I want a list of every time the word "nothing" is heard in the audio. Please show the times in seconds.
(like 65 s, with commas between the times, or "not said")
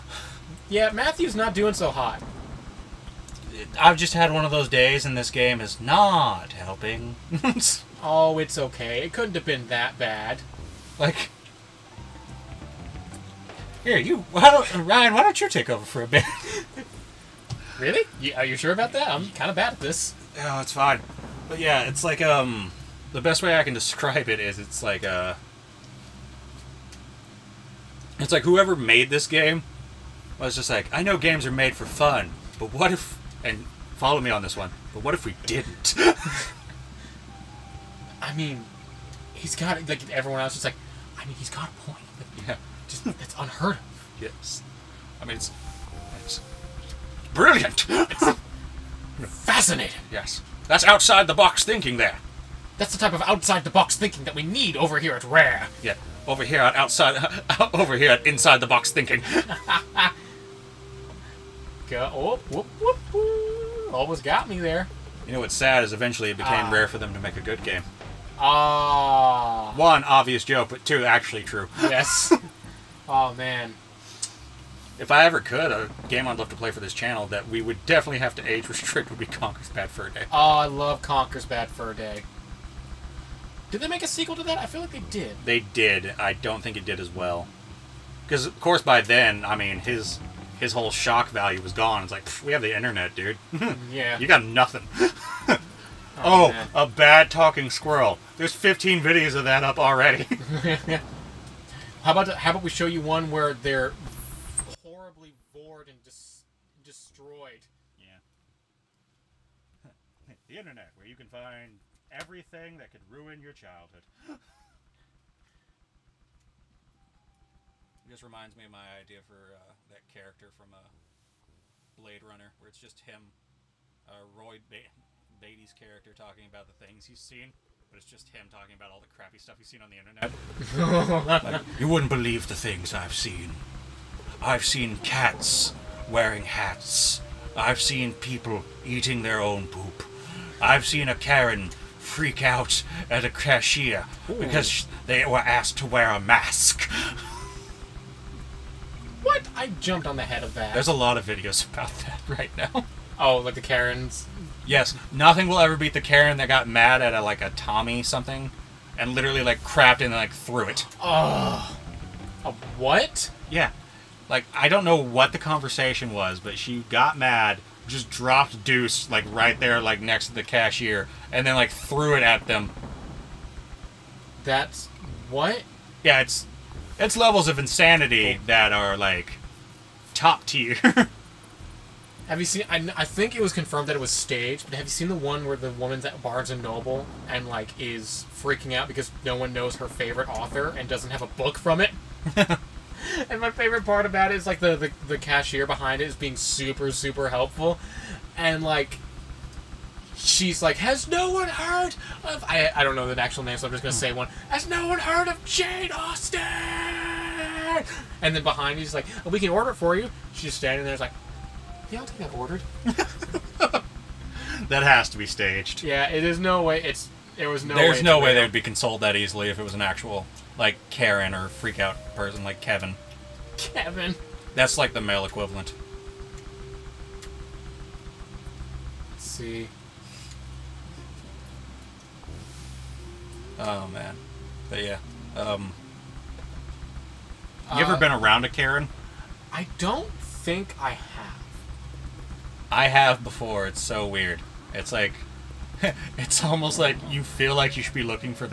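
94 s, 155 s.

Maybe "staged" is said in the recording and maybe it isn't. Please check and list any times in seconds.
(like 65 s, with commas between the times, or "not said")
184 s, 215 s.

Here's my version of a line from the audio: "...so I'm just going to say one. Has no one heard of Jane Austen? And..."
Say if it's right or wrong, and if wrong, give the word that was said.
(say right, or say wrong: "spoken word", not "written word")
right.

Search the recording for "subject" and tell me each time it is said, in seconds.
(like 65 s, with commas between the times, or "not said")
not said.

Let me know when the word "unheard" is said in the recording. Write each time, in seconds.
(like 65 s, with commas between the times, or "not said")
43 s.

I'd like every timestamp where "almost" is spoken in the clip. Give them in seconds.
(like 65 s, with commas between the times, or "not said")
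63 s, 246 s.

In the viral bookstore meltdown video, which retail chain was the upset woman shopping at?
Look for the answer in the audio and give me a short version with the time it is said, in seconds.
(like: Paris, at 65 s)
Barnes and Noble, at 186 s.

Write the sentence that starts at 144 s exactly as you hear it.
because they were asked to wear a mask.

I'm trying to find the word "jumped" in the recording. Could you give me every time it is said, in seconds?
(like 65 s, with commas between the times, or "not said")
149 s.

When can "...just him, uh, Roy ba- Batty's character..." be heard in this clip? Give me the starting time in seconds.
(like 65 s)
122 s.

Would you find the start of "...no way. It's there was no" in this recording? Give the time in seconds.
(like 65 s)
216 s.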